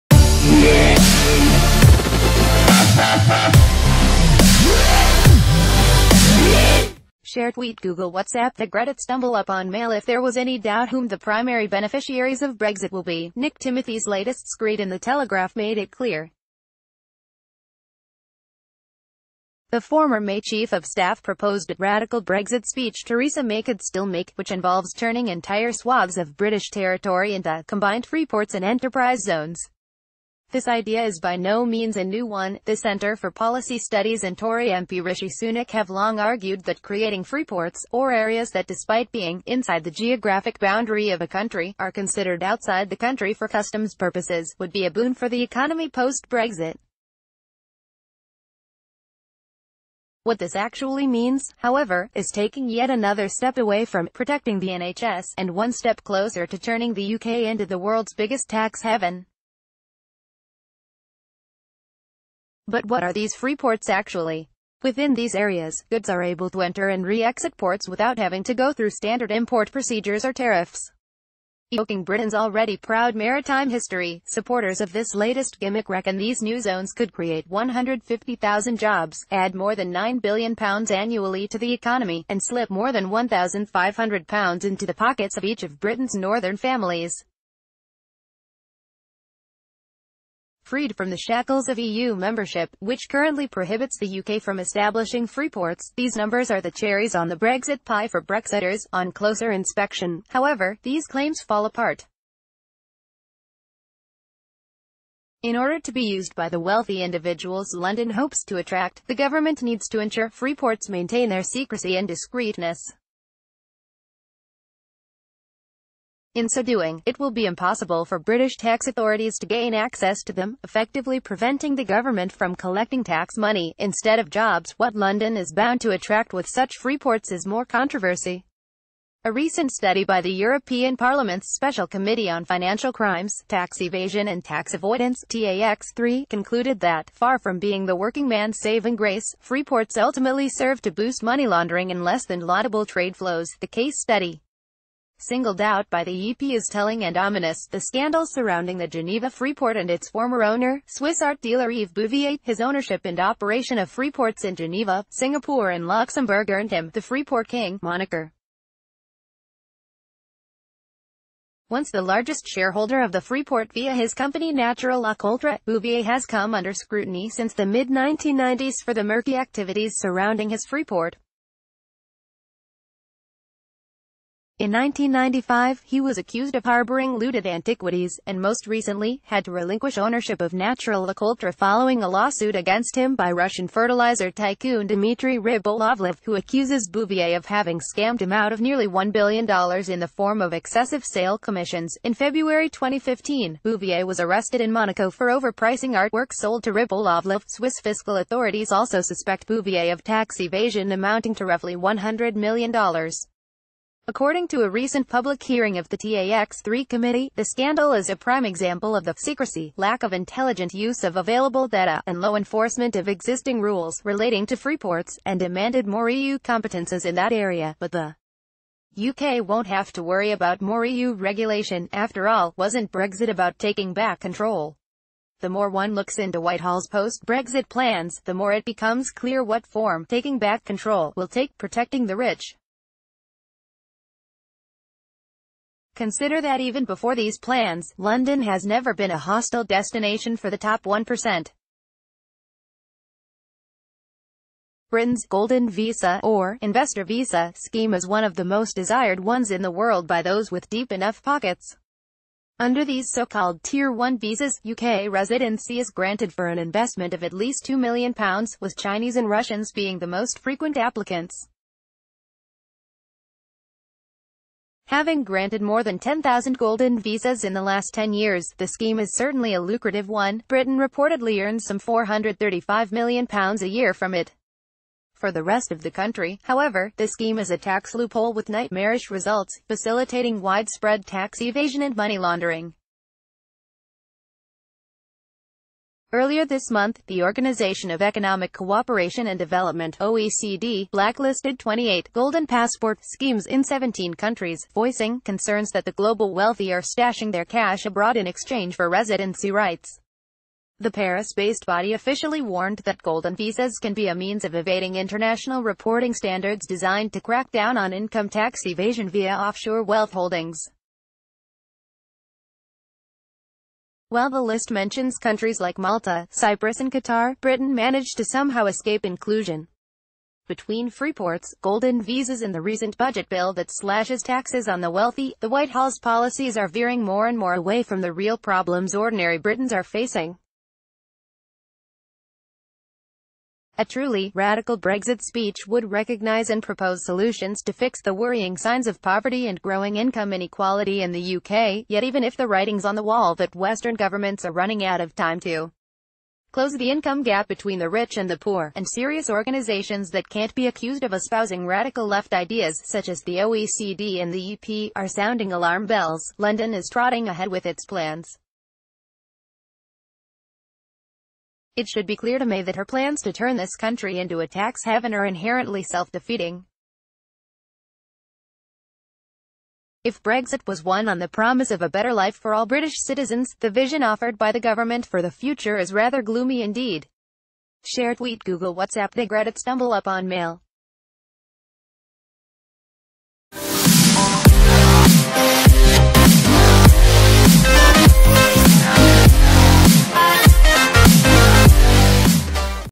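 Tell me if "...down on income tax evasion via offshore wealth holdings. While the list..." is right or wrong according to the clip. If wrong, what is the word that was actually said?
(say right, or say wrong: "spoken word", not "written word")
right.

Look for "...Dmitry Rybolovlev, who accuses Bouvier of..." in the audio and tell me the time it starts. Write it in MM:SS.
03:04.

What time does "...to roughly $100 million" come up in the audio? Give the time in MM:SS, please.
03:21.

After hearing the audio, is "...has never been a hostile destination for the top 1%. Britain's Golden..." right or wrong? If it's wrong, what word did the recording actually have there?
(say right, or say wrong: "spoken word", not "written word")
right.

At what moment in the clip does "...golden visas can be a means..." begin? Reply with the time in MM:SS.
05:03.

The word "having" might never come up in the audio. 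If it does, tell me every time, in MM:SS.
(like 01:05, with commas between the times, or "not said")
01:08, 03:07, 04:24.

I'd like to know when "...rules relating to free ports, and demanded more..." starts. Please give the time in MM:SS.
03:33.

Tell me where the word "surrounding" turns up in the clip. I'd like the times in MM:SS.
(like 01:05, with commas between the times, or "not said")
02:28, 02:49.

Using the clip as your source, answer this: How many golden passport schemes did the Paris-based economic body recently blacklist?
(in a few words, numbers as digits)
28.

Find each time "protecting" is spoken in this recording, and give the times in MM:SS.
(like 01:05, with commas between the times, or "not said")
00:54, 03:51.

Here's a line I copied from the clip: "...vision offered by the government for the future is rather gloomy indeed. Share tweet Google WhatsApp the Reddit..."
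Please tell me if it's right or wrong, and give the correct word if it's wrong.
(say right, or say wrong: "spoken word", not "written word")
right.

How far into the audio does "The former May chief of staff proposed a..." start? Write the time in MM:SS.
00:19.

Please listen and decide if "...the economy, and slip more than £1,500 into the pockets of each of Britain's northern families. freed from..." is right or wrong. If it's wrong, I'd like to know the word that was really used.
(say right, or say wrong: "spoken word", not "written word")
right.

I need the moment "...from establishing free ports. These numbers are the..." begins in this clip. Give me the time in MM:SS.
01:34.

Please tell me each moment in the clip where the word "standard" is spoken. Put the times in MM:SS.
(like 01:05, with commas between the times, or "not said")
01:08, 05:06.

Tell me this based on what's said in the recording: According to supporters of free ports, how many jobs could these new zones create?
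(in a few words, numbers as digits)
150,000.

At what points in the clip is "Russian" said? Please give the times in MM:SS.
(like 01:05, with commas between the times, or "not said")
03:03, 04:19.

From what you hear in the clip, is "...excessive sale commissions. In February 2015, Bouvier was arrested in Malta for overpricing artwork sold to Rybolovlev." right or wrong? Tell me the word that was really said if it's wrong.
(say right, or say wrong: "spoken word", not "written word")
wrong: "Monaco", not "Malta".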